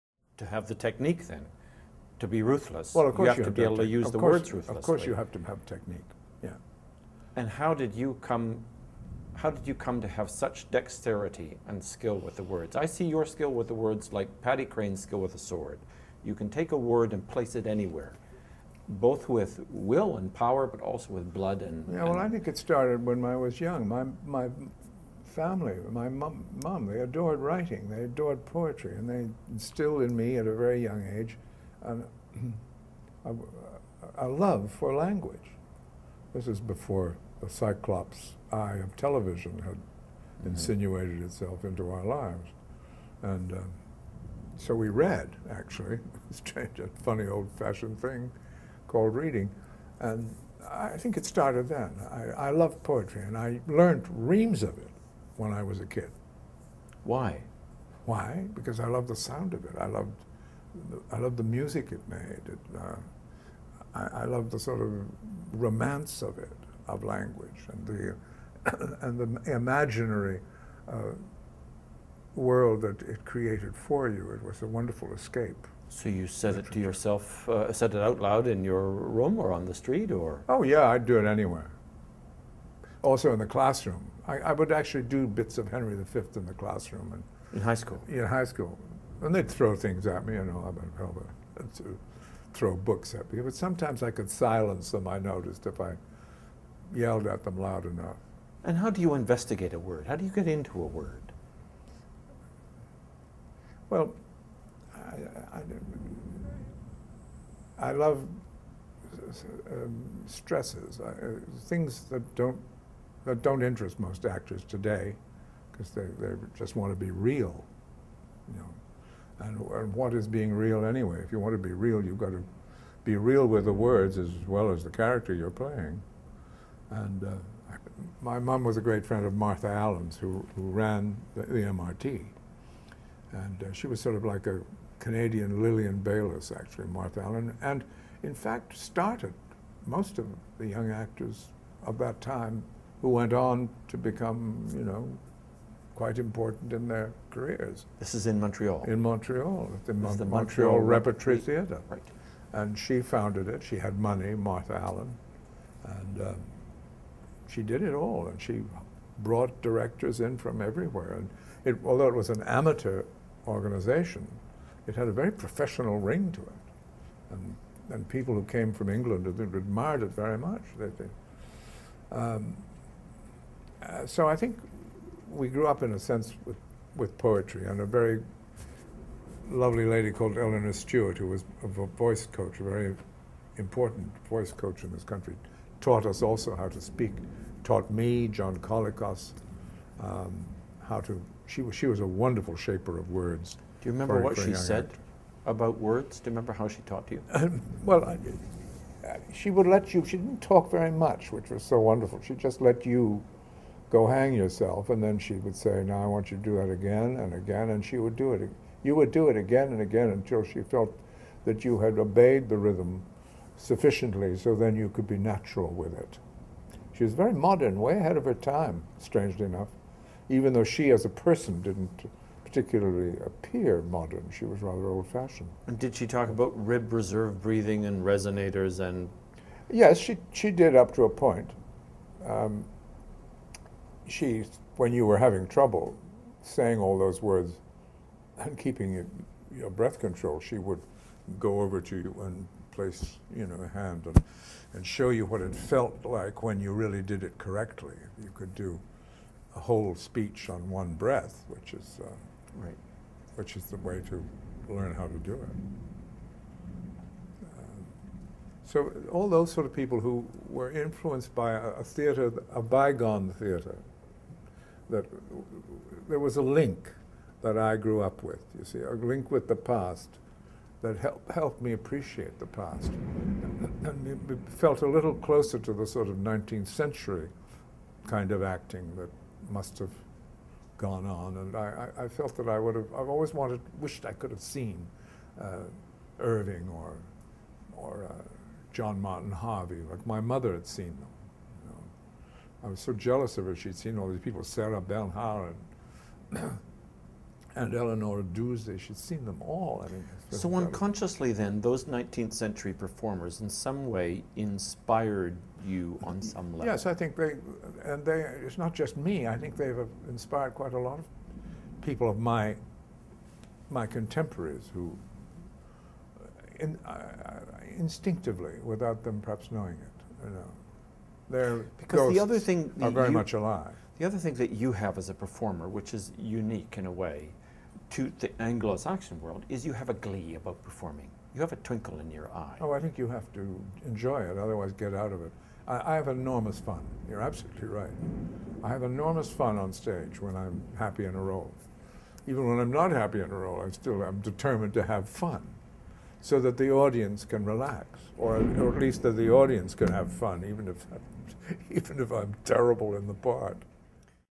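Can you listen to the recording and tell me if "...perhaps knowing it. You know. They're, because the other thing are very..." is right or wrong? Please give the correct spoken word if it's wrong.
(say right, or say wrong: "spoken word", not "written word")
right.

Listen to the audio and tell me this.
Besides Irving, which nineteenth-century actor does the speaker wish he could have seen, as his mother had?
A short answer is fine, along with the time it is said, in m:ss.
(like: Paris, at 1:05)
John Martin Harvey, at 4:48.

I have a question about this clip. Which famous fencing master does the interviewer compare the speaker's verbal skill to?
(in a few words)
Paddy Crean.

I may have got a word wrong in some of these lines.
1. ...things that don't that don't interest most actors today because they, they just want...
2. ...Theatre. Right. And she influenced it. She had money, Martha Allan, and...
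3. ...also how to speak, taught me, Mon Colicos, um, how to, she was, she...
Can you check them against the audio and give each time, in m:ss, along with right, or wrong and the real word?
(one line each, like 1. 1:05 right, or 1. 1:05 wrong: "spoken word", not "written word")
1. 1:51 right
2. 2:31 wrong: "founded", not "influenced"
3. 3:06 wrong: "John", not "Mon".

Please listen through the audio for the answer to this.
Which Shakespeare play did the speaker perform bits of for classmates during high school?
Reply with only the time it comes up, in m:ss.
1:25.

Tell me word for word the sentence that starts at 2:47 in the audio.
And, and people who came from England admired it very much.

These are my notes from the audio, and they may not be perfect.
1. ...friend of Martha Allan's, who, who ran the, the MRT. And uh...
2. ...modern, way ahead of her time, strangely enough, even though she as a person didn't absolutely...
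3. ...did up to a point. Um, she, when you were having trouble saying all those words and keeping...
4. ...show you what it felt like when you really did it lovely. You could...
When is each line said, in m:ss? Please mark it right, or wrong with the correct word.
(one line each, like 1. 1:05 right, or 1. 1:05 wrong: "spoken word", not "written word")
1. 2:09 right
2. 3:37 wrong: "particularly", not "absolutely"
3. 3:50 right
4. 4:04 wrong: "correctly", not "lovely".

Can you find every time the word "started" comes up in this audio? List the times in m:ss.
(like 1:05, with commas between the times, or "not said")
0:22, 0:51, 2:18.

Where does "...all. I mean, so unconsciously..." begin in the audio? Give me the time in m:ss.
4:59.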